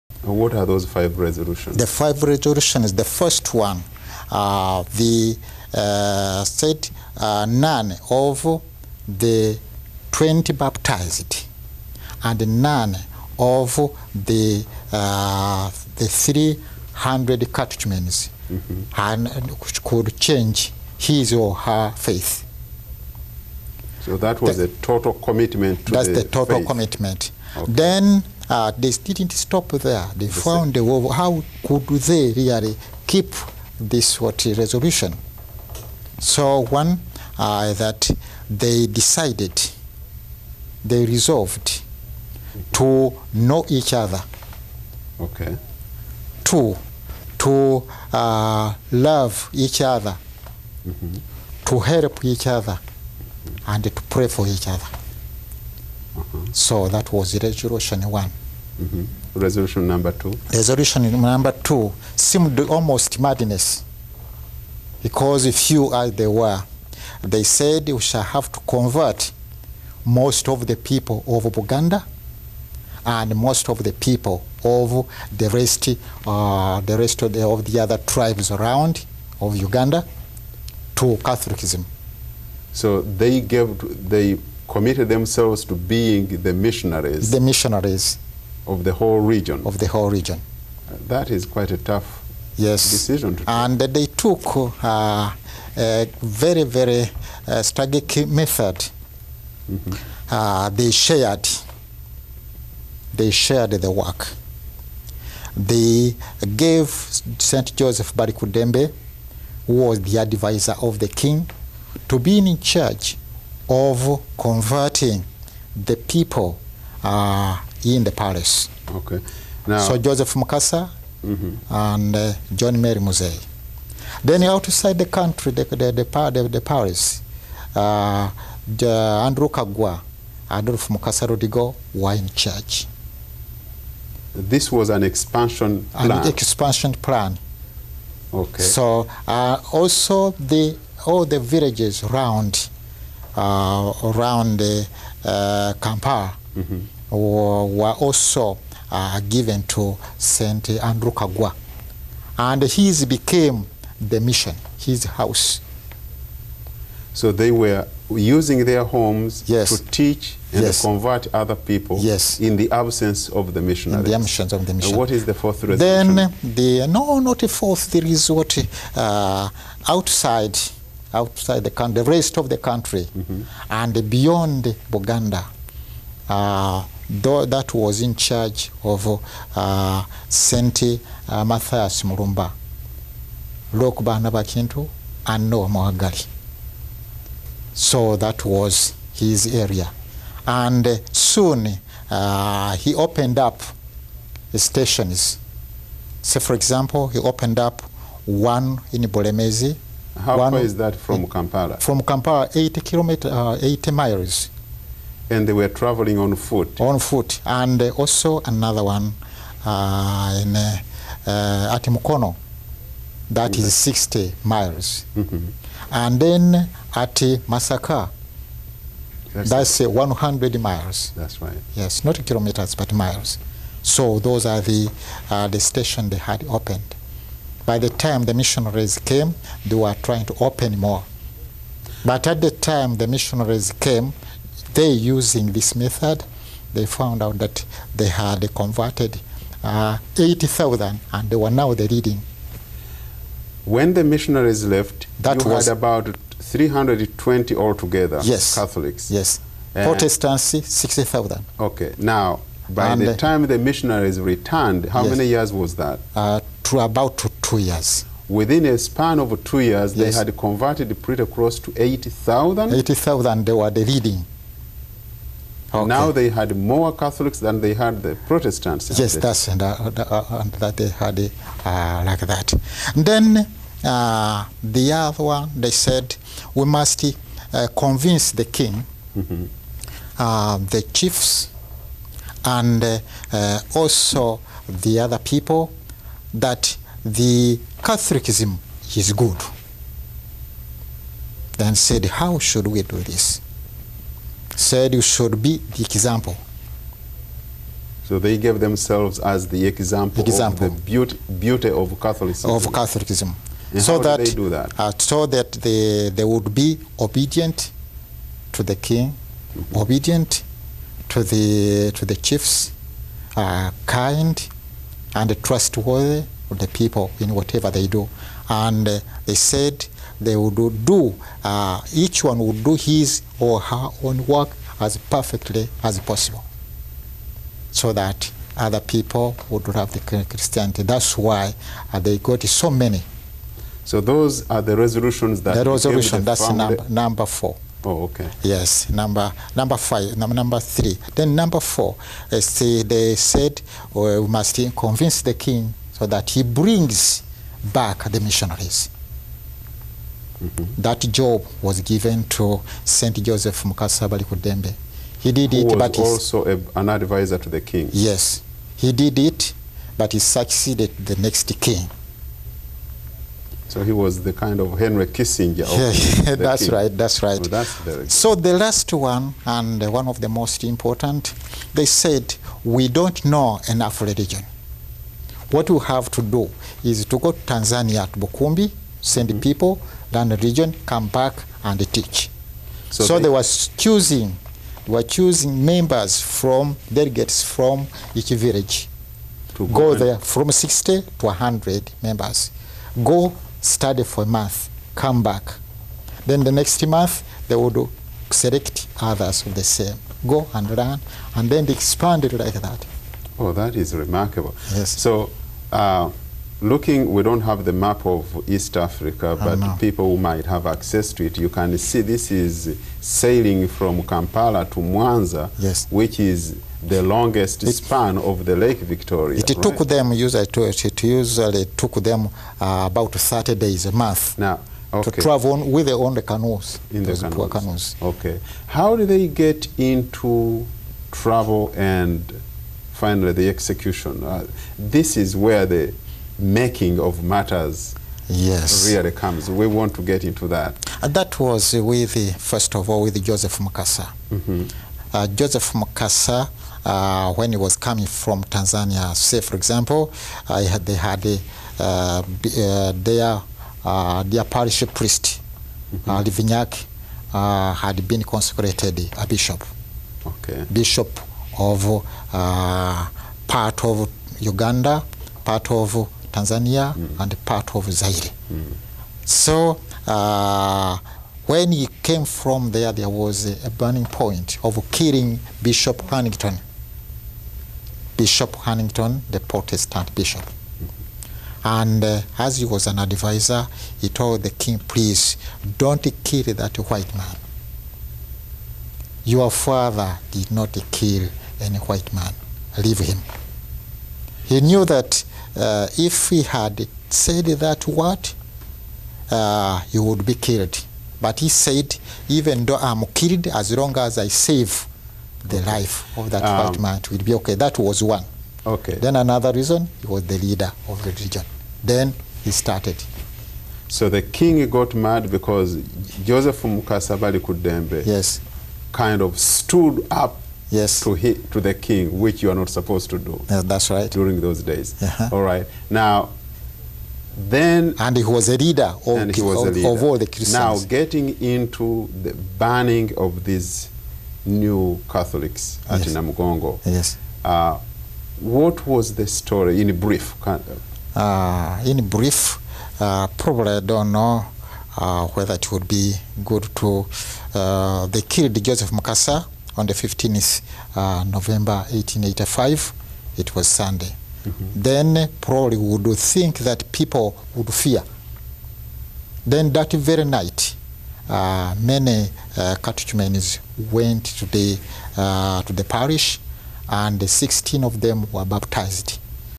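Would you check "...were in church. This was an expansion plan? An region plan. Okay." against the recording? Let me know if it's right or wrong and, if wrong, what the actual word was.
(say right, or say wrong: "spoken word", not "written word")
wrong: "expansion", not "region".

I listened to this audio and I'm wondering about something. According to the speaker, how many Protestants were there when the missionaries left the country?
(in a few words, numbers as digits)
60,000.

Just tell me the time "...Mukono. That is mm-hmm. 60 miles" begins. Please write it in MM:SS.
03:31.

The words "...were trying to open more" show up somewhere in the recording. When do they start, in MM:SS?
03:49.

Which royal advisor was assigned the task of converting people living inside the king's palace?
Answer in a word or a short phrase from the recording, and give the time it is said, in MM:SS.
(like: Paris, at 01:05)
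Joseph Balikuddembe, at 01:47.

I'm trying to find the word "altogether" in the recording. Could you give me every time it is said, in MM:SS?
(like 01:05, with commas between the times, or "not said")
04:07.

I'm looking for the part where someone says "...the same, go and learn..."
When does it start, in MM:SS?
06:39.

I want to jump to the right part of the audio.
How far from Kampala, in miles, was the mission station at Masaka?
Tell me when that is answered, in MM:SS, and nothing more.
03:39.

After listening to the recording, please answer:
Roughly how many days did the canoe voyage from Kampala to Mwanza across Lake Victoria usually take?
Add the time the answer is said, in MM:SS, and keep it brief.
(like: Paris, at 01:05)
30 days, at 07:03.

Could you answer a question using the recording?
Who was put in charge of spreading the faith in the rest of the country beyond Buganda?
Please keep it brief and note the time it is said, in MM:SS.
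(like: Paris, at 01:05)
Mathias Mulumba, at 03:01.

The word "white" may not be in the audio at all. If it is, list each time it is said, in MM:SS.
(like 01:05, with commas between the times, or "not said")
08:06, 08:11, 08:26.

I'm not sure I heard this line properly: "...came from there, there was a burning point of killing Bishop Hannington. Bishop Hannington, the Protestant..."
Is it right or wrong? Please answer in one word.
right.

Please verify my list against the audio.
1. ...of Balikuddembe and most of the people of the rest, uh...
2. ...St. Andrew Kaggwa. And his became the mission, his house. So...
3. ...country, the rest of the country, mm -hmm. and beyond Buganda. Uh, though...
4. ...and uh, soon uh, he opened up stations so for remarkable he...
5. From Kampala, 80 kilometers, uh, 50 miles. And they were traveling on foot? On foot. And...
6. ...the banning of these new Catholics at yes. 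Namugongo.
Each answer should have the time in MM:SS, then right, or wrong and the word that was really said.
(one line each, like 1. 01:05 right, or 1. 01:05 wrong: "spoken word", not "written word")
1. 01:11 wrong: "Buganda", not "Balikuddembe"
2. 02:30 right
3. 02:51 right
4. 03:10 wrong: "example", not "remarkable"
5. 03:21 wrong: "80", not "50"
6. 08:52 right.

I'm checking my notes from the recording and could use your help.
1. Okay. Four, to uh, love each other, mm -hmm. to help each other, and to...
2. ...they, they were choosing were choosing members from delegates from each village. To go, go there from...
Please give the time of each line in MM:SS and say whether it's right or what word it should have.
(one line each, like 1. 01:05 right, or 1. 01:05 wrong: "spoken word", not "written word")
1. 00:45 wrong: "Two", not "Four"
2. 06:23 right.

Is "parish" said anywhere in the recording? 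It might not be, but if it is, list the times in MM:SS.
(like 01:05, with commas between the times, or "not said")
07:34, 09:25.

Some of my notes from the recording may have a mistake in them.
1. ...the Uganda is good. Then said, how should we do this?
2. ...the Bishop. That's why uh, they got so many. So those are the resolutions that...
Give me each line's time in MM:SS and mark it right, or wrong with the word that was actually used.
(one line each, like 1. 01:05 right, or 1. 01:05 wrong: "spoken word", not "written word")
1. 04:47 wrong: "Catholicism", not "Uganda"
2. 05:29 wrong: "Christianity", not "Bishop".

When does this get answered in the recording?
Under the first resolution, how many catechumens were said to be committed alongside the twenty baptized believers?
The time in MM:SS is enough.
00:16.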